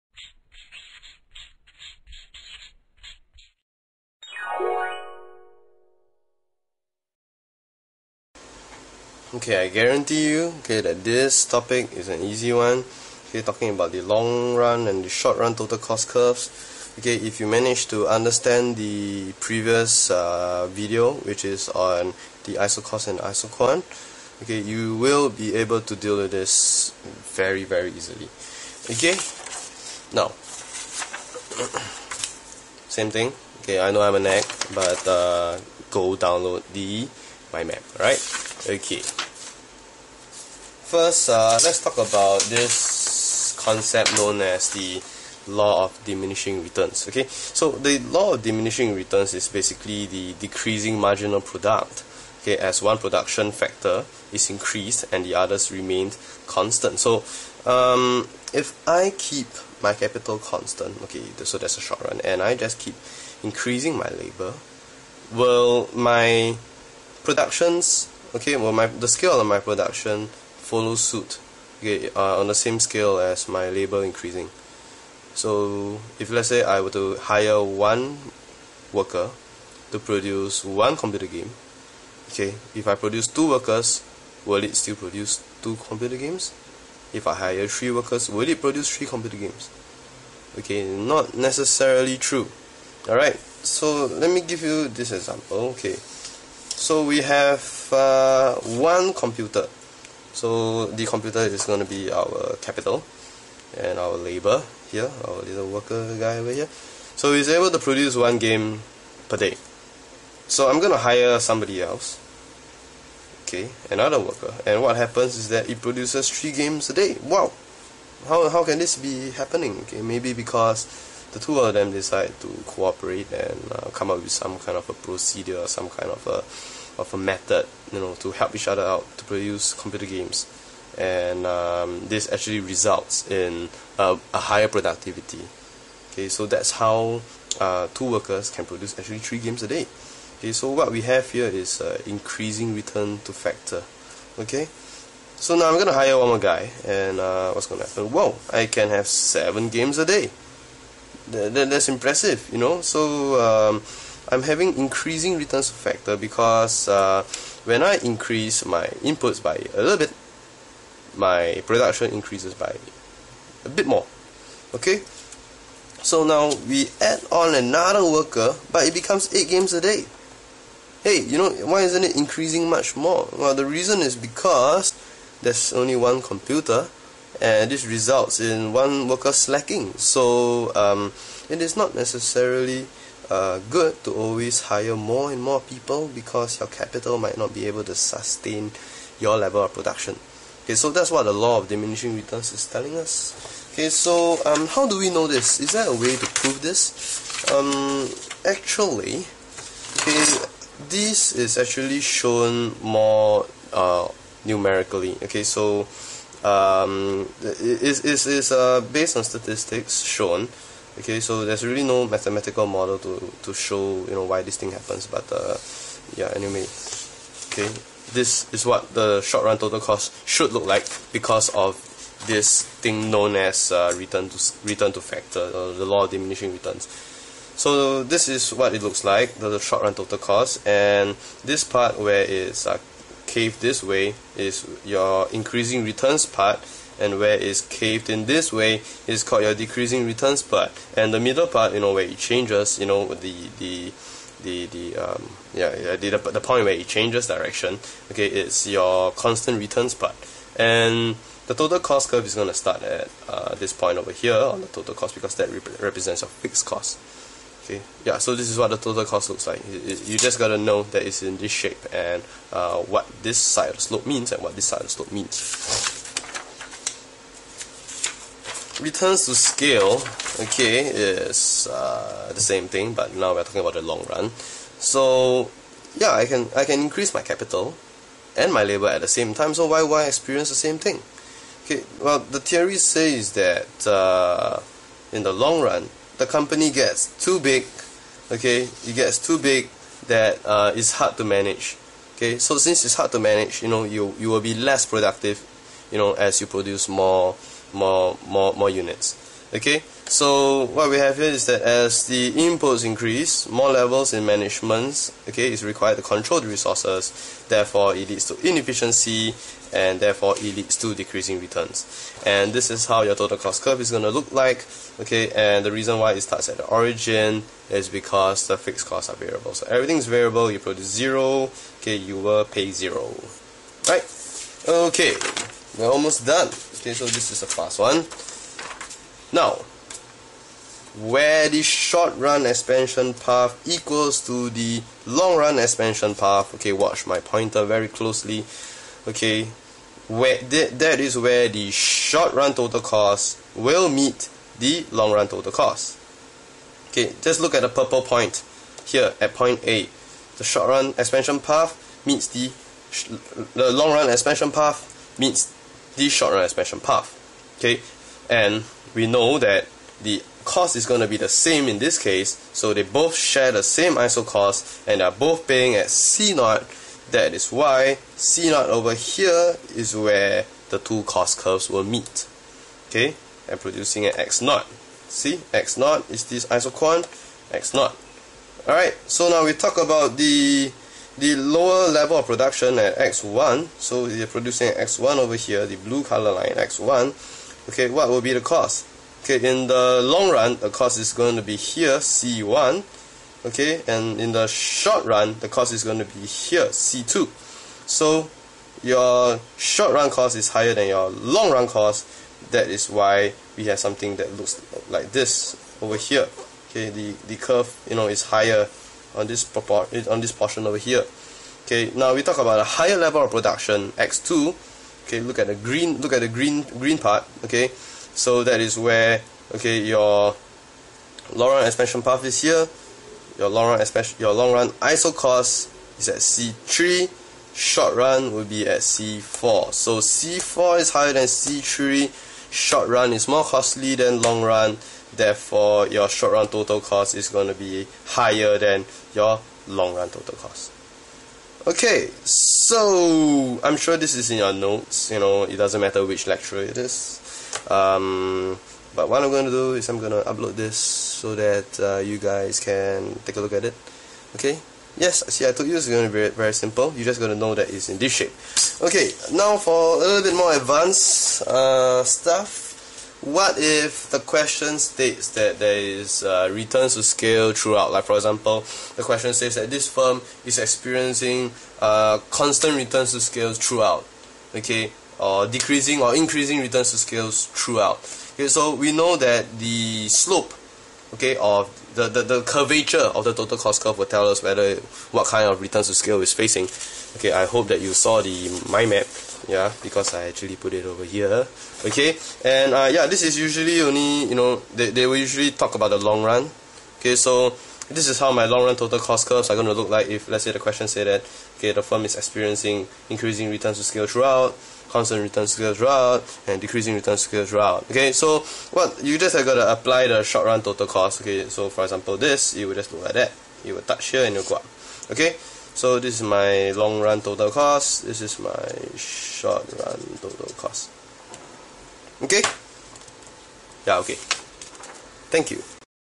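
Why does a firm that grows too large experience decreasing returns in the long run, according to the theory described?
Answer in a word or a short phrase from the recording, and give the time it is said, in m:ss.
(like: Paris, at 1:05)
More levels in management, at 5:03.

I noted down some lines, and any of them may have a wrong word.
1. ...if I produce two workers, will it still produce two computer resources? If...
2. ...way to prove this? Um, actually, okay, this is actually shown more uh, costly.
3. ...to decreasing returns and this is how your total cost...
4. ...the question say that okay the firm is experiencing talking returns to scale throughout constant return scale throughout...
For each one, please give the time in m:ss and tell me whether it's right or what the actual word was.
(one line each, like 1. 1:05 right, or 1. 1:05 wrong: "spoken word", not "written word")
1. 1:22 wrong: "games", not "resources"
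2. 3:15 wrong: "numerically", not "costly"
3. 5:10 right
4. 8:20 wrong: "increasing", not "talking".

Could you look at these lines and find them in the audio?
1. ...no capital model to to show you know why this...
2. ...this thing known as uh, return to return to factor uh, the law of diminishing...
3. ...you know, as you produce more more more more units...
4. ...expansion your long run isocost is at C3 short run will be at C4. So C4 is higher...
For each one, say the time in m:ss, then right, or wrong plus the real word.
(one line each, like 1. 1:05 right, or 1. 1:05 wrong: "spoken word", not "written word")
1. 3:31 wrong: "mathematical", not "capital"
2. 3:42 right
3. 4:55 right
4. 7:03 right.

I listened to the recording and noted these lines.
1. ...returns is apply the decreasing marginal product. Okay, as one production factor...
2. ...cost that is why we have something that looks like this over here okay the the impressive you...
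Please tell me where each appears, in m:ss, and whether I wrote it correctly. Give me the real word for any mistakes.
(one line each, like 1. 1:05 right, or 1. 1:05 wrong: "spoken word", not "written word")
1. 0:48 wrong: "basically", not "apply"
2. 6:41 wrong: "curve", not "impressive".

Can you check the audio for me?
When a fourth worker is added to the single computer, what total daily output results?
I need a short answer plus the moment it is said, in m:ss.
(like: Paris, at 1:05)
8 games a day, at 2:49.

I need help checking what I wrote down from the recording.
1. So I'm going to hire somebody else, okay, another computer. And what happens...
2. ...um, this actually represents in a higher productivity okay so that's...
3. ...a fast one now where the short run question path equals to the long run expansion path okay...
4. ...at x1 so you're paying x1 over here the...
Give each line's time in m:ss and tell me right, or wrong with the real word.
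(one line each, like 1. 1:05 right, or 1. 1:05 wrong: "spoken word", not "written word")
1. 1:50 wrong: "worker", not "computer"
2. 2:11 wrong: "results", not "represents"
3. 5:27 wrong: "expansion", not "question"
4. 6:22 wrong: "producing", not "paying".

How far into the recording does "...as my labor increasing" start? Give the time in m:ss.
1:13.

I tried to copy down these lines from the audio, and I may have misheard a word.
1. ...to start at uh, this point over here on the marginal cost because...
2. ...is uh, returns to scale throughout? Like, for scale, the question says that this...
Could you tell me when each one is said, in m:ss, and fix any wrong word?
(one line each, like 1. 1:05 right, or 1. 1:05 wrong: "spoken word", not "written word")
1. 4:12 wrong: "total", not "marginal"
2. 7:45 wrong: "example", not "scale".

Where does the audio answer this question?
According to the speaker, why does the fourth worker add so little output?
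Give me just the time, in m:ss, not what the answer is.
2:55.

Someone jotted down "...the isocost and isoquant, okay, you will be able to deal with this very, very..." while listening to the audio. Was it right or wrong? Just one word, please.
right.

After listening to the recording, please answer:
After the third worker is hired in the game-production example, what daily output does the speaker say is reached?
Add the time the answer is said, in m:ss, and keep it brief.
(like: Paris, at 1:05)
7 games a day, at 2:29.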